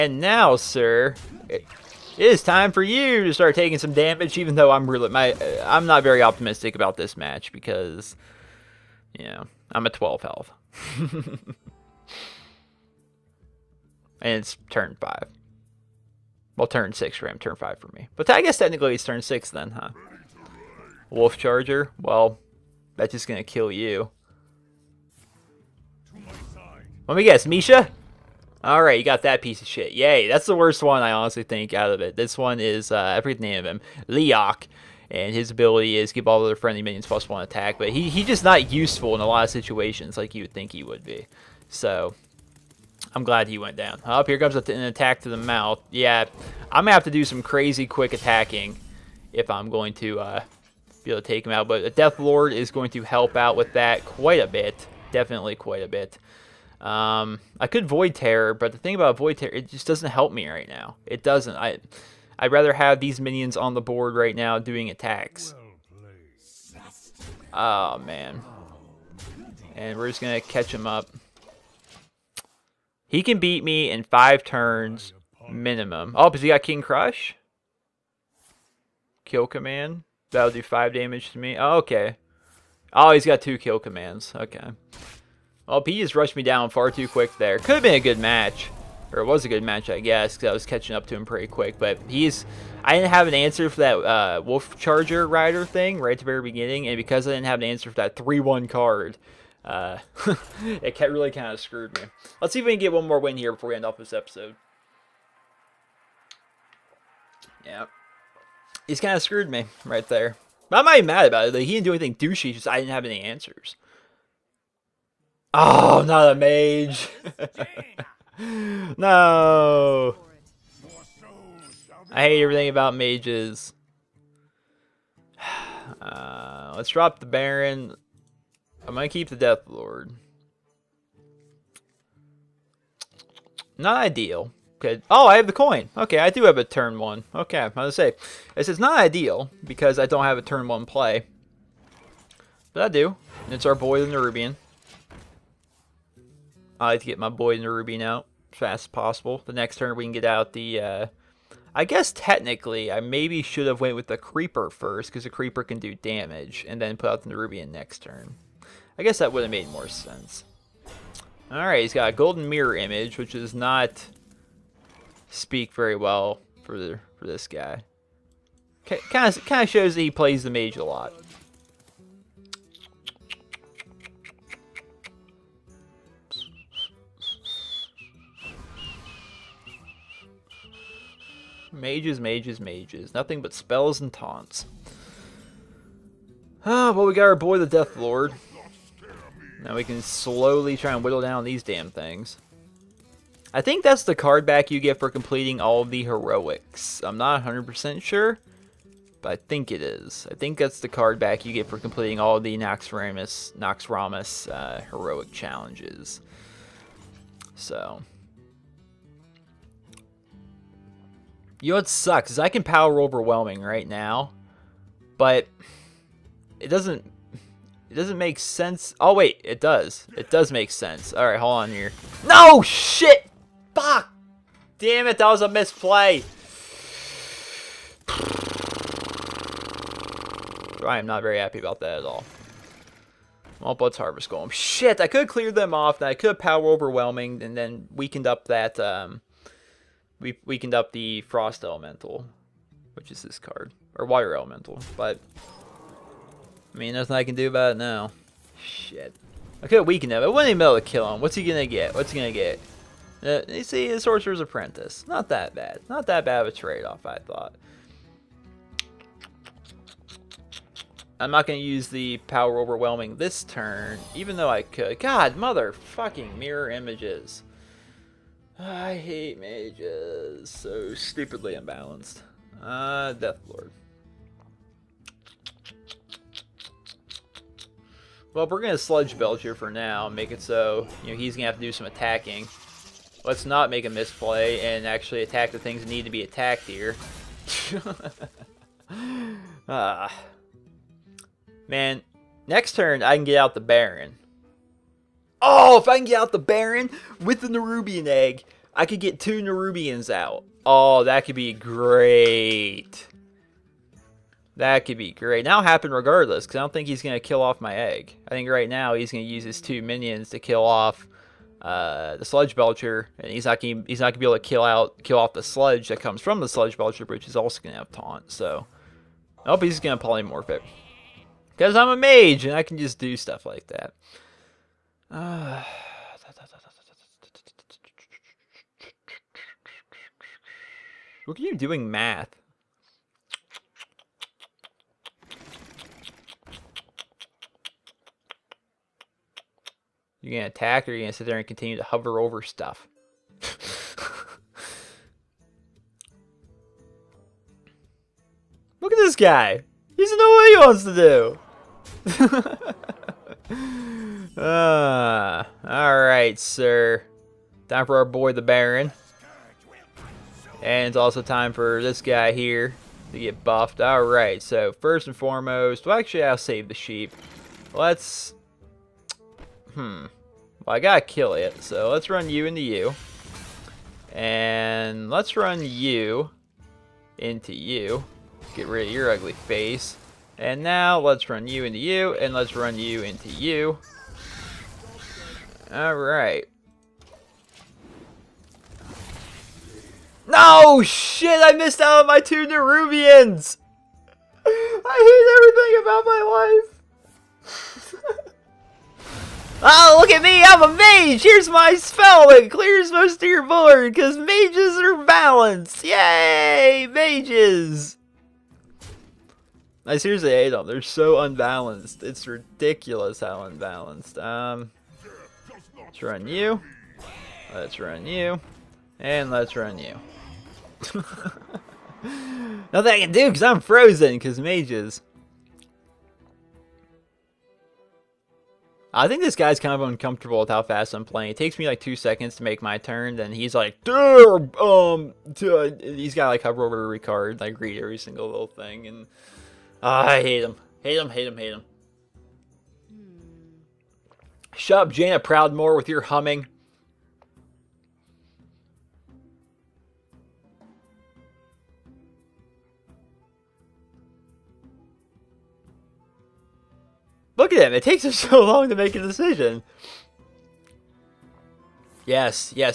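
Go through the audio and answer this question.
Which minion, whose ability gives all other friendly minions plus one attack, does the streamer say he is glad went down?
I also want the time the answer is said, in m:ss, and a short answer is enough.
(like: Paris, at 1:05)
Leokk, at 0:34.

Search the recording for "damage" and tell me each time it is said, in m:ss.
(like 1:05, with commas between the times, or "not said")
0:03, 1:20, 2:35.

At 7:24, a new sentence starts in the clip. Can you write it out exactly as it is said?
Shut up, Jaina Proudmoore, with your humming.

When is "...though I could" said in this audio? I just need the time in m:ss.
4:24.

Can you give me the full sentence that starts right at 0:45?
Yeah, I'm going to have to do some crazy quick attacking if I'm going to uh, be able to take him out.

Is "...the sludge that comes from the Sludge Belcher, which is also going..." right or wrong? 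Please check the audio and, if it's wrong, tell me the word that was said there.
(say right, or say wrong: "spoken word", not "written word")
right.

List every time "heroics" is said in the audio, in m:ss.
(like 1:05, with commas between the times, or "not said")
3:16, 3:24.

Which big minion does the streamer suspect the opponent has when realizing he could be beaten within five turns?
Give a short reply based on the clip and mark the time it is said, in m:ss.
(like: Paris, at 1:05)
King Krush, at 1:16.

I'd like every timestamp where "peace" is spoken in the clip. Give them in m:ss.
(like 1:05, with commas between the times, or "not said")
not said.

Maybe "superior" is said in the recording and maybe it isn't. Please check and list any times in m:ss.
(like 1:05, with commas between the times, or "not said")
not said.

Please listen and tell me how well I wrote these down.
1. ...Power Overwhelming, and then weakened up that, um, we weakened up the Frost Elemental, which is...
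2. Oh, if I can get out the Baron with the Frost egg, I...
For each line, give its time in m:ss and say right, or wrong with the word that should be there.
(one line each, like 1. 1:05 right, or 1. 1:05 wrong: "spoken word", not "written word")
1. 3:56 right
2. 4:55 wrong: "Nerubian", not "Frost".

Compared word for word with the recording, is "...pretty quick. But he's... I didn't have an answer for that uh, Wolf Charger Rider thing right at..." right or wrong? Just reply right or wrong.
right.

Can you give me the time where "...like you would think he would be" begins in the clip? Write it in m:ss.
0:40.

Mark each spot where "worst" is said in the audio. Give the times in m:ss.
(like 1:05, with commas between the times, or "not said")
0:30.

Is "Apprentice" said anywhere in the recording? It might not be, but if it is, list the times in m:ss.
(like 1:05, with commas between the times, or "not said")
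4:14.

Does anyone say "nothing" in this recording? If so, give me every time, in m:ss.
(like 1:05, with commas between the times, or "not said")
3:03, 4:06, 7:02.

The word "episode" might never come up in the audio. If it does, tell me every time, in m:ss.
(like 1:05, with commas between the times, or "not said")
1:44.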